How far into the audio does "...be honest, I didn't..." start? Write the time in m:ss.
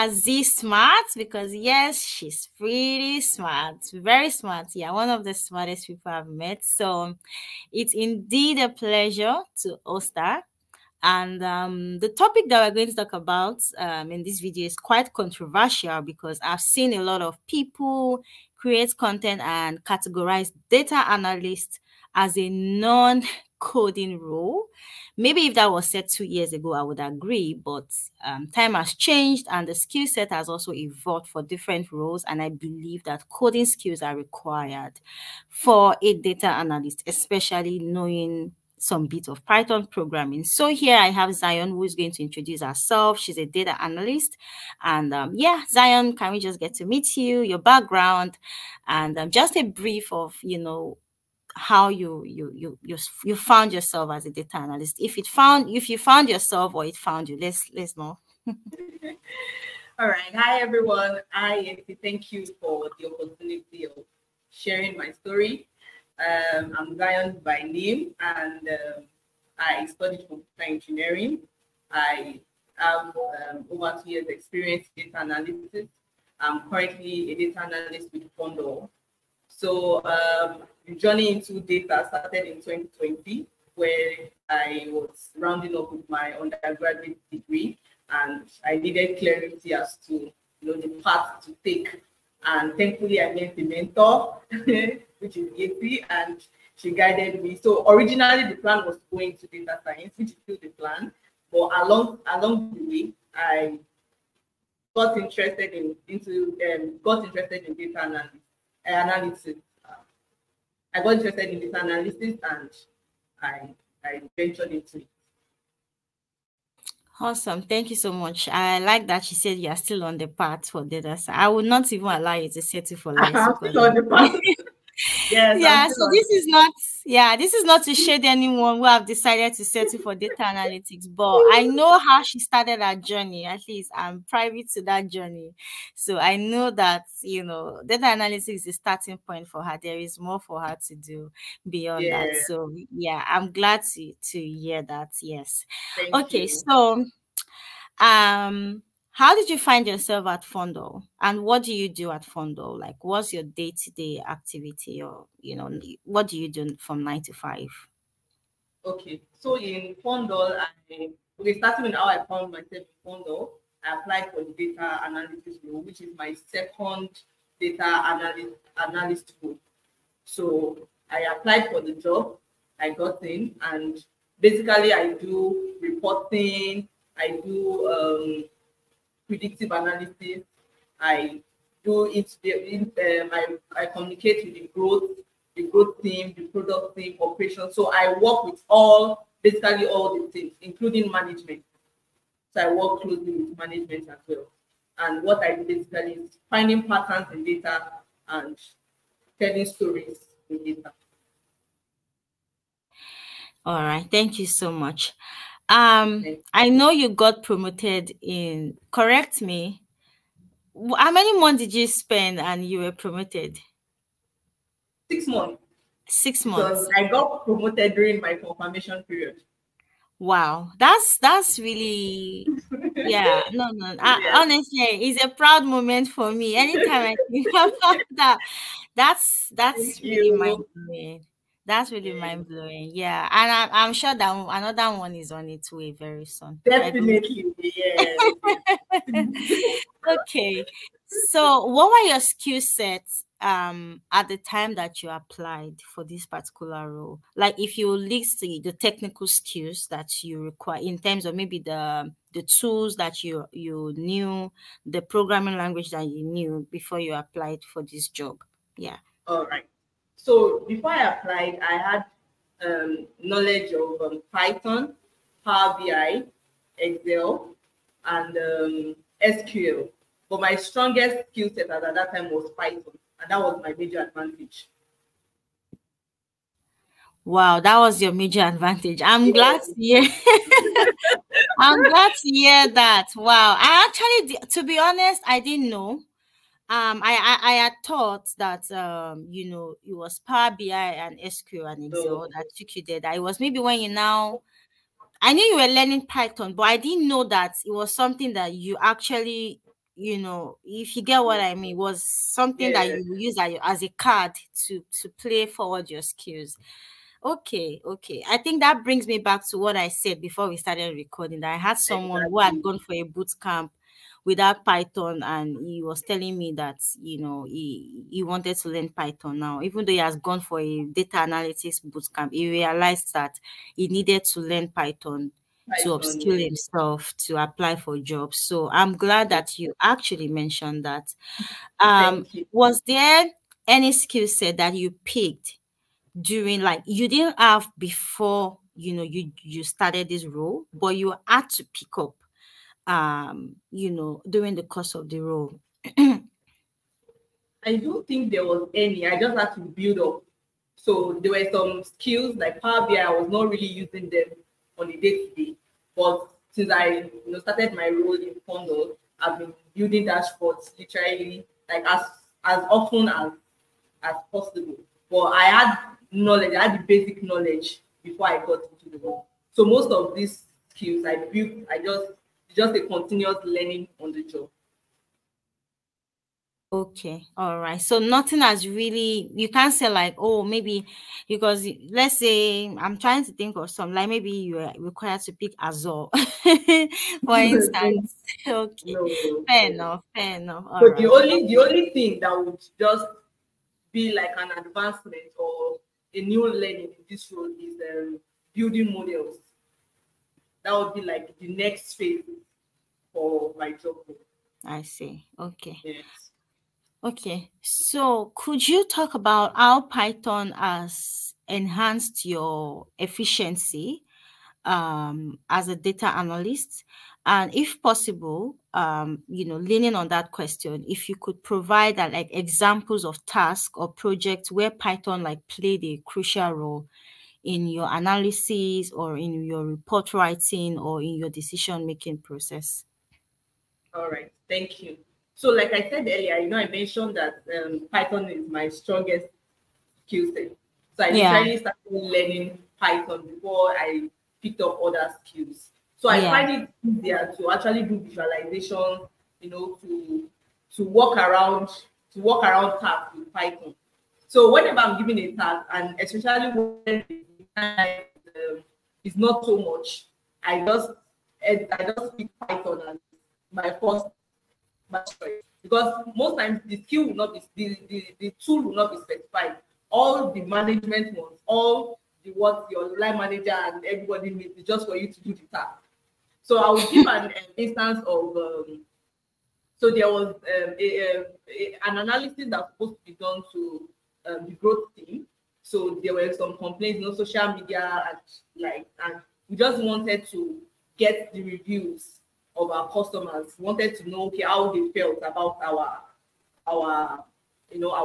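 4:44.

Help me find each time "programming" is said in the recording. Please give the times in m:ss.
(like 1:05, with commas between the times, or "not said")
0:39, 4:15.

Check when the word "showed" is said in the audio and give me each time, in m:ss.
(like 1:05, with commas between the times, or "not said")
not said.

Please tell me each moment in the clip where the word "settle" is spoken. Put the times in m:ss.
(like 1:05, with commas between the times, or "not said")
2:02, 2:09.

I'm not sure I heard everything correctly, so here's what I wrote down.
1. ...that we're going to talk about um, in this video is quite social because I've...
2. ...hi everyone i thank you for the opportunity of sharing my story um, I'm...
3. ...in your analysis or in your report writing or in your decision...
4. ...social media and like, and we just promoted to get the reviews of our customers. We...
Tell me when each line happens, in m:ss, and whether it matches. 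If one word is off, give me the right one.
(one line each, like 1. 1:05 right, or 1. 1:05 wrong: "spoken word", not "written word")
1. 0:12 wrong: "controversial", not "social"
2. 1:00 right
3. 7:07 right
4. 8:07 wrong: "wanted", not "promoted".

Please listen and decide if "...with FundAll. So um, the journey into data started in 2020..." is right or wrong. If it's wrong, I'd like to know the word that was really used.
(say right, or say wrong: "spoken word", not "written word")
right.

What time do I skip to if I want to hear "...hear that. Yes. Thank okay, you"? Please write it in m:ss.
2:24.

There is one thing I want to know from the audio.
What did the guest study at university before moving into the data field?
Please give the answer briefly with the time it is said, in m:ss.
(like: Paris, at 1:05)
Computer engineering, at 1:10.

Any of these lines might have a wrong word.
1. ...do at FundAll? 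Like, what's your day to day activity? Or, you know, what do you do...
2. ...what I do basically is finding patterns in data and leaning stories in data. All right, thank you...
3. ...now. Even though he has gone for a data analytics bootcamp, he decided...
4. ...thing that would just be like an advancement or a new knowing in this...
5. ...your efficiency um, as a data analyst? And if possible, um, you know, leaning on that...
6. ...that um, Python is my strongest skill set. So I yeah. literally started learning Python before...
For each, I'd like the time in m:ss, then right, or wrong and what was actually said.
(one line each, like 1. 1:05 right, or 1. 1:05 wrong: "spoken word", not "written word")
1. 2:31 right
2. 3:15 wrong: "telling", not "leaning"
3. 5:19 wrong: "realized", not "decided"
4. 6:31 wrong: "learning", not "knowing"
5. 6:52 right
6. 7:17 right.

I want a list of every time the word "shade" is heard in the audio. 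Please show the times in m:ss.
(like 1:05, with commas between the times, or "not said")
2:07.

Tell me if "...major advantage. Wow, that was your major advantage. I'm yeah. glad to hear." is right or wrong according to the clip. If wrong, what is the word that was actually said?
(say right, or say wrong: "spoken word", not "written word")
right.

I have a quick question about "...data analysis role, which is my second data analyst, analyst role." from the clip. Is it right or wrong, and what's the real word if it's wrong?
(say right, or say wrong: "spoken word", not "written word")
right.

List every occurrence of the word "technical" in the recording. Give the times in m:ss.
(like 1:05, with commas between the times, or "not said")
4:08.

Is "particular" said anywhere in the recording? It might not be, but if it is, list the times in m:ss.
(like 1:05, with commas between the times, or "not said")
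4:06.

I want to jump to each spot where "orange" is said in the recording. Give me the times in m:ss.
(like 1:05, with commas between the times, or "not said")
not said.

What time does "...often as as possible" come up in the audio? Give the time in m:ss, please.
6:02.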